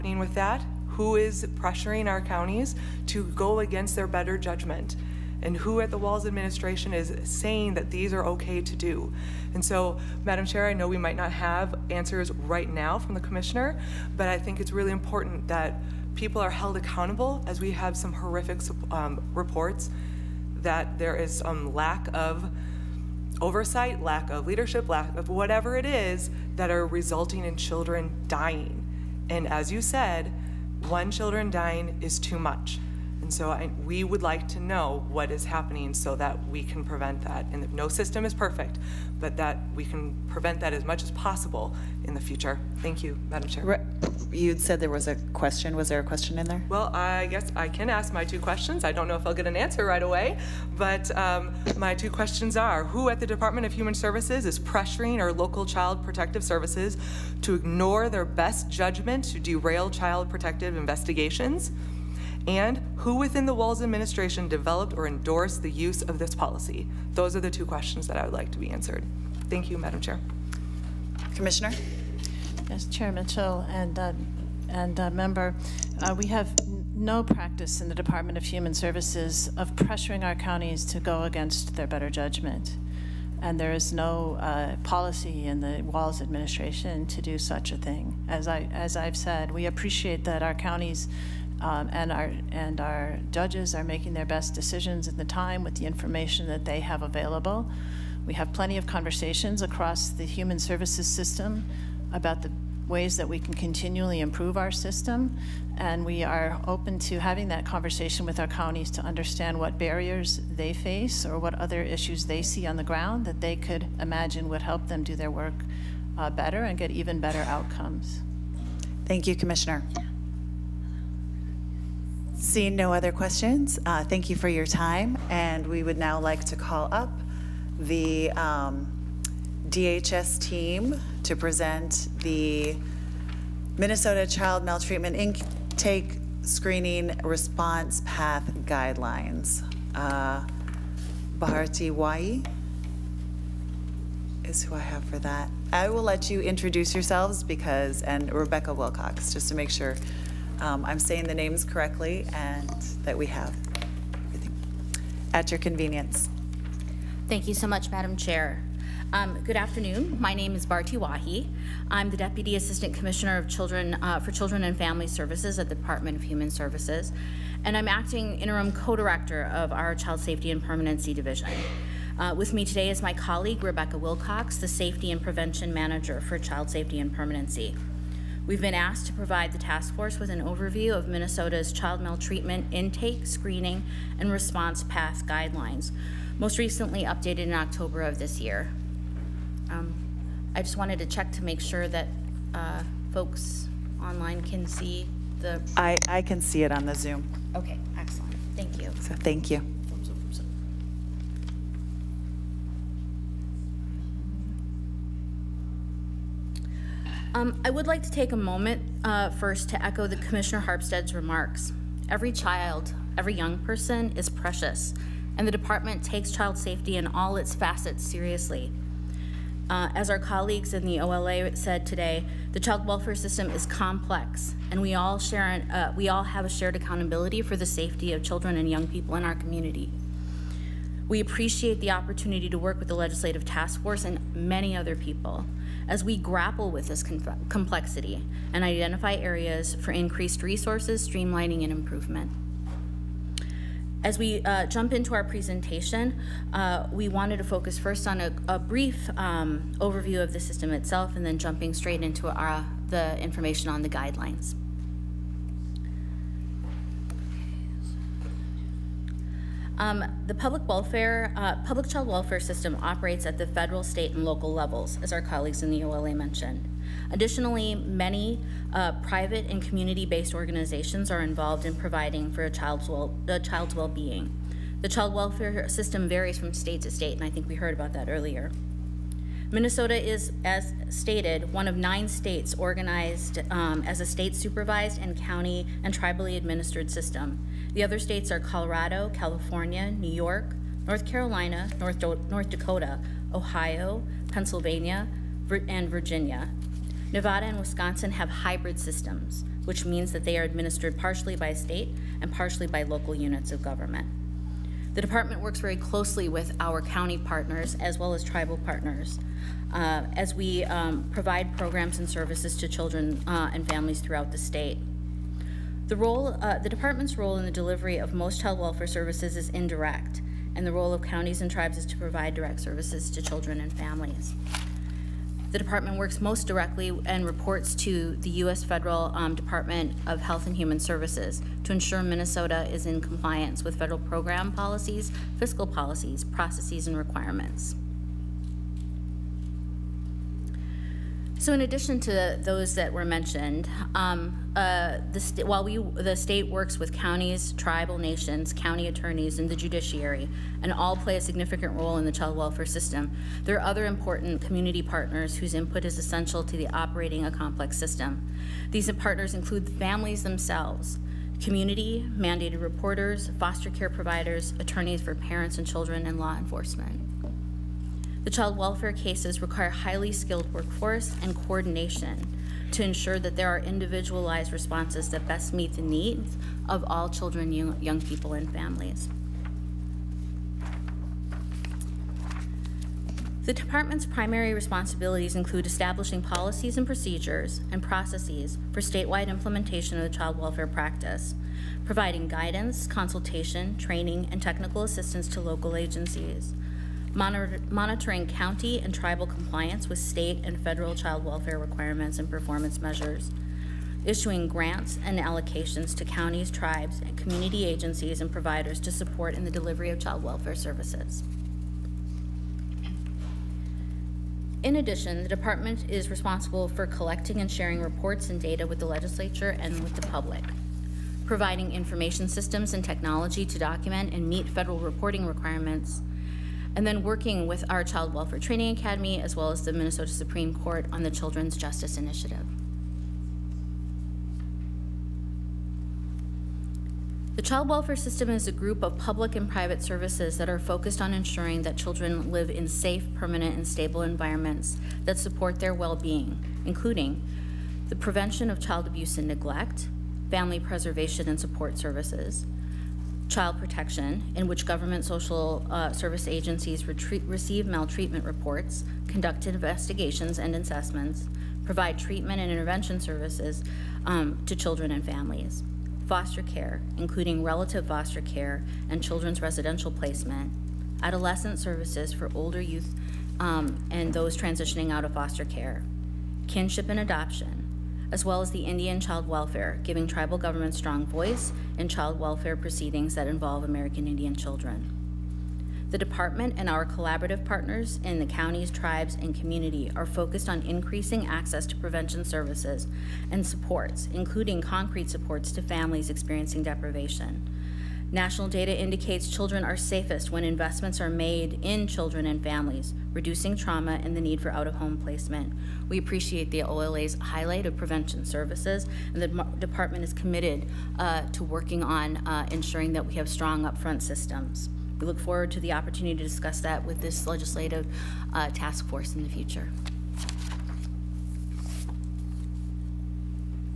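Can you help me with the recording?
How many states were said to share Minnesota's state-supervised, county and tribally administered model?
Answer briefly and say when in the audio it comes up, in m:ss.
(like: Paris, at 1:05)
9, at 4:41.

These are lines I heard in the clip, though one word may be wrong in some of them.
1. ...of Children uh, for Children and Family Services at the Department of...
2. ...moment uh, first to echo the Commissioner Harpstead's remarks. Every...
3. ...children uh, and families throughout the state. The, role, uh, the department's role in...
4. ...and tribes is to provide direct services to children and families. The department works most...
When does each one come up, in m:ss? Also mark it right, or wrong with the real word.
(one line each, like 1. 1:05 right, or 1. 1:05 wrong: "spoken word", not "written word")
1. 2:43 right
2. 3:28 right
3. 5:12 right
4. 5:21 right.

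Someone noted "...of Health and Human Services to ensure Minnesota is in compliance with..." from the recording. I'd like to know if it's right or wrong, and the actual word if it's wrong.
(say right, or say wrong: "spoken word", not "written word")
right.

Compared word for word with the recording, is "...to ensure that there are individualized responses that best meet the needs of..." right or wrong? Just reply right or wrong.
right.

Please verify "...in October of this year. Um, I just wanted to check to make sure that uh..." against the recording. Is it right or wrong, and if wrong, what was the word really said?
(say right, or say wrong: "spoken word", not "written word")
right.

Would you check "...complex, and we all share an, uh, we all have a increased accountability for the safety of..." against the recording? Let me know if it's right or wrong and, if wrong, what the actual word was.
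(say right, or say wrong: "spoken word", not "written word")
wrong: "shared", not "increased".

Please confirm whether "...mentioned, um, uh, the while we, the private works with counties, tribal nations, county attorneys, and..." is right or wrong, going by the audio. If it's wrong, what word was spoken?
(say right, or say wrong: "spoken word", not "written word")
wrong: "state", not "private".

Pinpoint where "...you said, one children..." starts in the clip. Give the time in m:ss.
0:29.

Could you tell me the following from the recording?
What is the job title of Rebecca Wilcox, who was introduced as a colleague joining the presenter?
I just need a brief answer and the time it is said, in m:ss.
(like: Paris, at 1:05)
Safety and Prevention Manager, at 2:54.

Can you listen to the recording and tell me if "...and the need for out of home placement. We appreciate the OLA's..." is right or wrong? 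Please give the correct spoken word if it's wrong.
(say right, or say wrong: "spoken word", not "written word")
right.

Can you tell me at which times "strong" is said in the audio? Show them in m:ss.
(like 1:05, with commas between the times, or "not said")
8:00, 8:33.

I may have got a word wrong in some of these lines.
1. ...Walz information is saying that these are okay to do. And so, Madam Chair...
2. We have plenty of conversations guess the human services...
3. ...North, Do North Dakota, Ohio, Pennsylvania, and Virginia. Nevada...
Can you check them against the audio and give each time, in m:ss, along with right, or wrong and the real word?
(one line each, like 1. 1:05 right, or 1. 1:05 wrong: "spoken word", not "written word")
1. 0:05 wrong: "administration", not "information"
2. 1:38 wrong: "across", not "guess"
3. 4:51 right.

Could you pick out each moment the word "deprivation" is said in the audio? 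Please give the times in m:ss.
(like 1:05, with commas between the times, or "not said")
8:16.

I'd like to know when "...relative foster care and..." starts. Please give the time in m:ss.
7:47.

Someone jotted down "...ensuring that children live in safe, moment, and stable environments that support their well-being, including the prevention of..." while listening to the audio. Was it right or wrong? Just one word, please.
wrong.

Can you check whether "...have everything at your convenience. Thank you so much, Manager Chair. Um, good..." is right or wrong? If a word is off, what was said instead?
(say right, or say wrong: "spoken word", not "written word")
wrong: "Madam", not "Manager".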